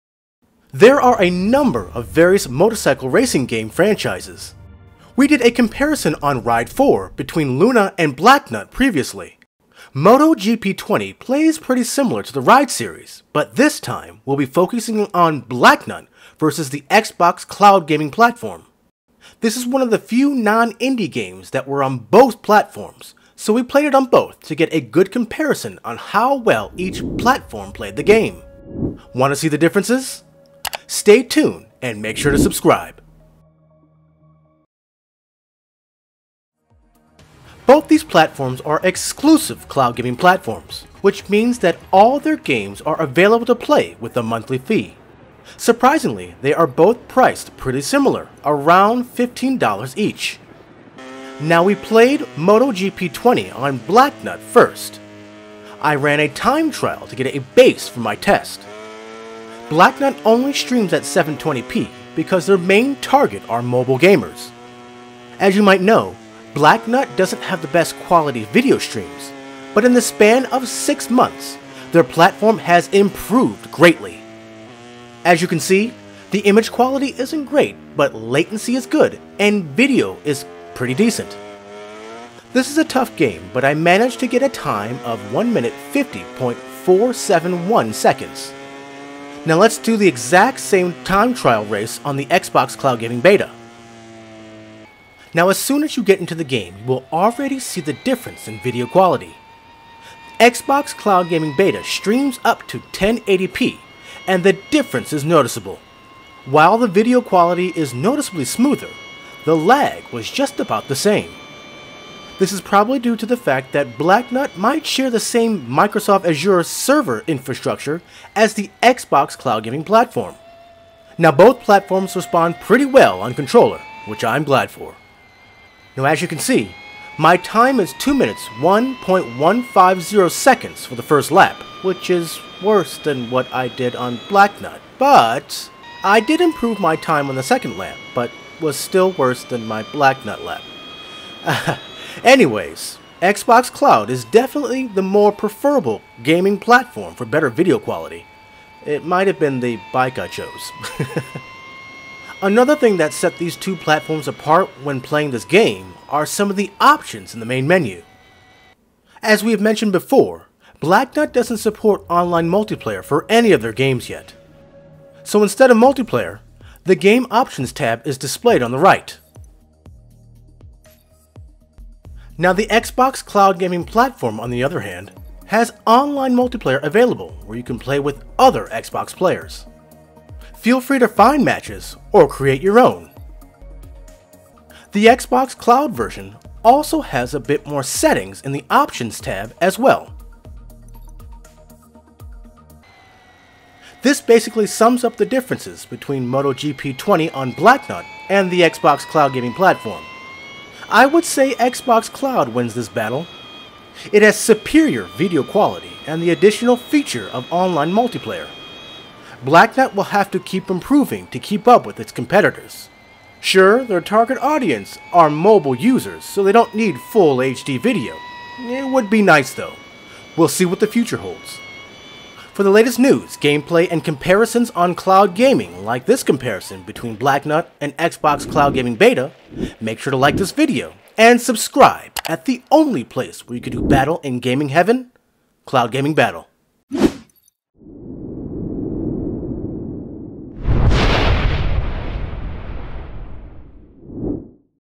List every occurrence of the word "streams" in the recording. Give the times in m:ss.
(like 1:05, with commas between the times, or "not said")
1:00, 1:08, 1:41.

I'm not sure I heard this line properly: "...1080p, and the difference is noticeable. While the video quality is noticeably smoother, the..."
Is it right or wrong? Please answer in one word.
right.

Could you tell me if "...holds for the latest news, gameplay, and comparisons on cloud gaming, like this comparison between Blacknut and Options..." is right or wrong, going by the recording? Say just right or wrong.
wrong.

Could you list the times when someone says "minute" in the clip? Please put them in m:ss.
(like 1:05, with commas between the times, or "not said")
1:25, 2:08.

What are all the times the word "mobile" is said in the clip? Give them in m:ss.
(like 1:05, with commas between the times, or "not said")
1:03, 3:35.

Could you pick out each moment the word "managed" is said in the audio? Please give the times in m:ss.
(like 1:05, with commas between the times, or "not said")
1:23.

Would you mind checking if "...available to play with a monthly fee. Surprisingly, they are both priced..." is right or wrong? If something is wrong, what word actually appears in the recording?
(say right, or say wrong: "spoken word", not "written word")
right.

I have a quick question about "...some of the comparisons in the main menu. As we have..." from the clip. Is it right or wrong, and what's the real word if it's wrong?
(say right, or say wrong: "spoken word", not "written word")
wrong: "options", not "comparisons".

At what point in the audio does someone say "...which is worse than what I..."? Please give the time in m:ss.
2:11.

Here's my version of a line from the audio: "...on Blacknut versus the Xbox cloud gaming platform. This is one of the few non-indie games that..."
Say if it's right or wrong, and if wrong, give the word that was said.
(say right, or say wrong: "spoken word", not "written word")
right.